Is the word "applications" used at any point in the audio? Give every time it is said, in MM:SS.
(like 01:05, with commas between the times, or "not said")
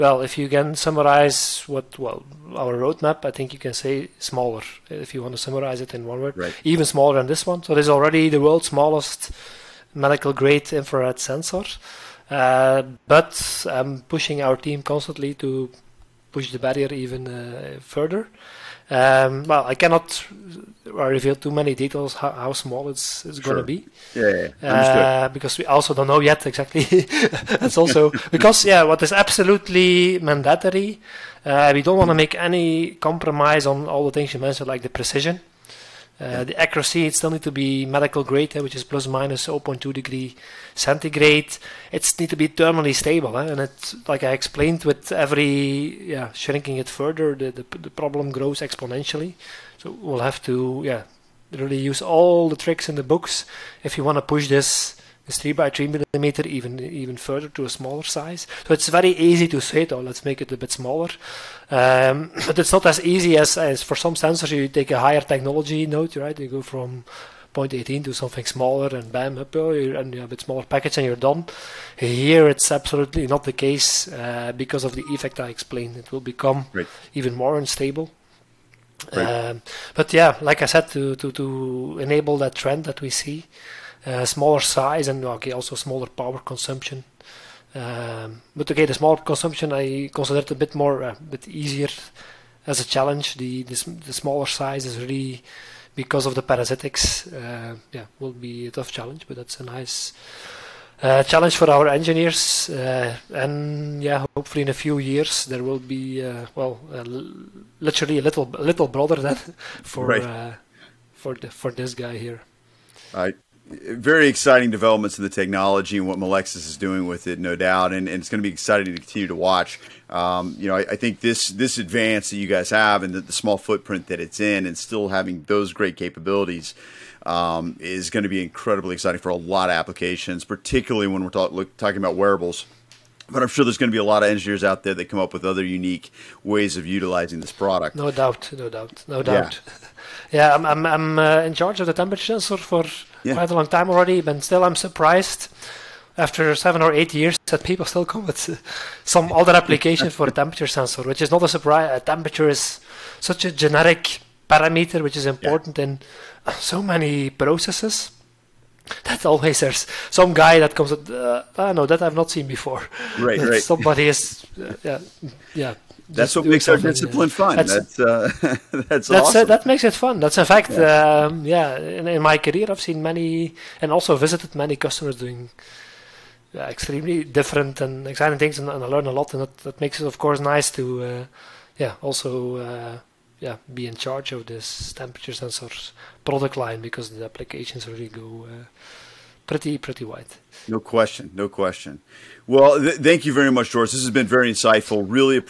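02:09, 02:29, 03:07.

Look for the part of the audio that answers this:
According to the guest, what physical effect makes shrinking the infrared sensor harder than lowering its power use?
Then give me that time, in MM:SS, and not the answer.
01:36.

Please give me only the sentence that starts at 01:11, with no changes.
Here it's absolutely not the case uh, because of the effect I explained.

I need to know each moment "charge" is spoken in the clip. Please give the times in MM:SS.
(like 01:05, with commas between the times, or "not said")
02:21, 03:03.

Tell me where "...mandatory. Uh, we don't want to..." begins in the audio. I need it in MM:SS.
00:30.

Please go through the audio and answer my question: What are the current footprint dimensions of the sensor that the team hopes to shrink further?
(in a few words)
3 by 3 millimeters.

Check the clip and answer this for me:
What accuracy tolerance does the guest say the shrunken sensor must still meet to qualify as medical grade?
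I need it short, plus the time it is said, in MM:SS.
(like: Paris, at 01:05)
plus or minus 0.2 °C, at 00:38.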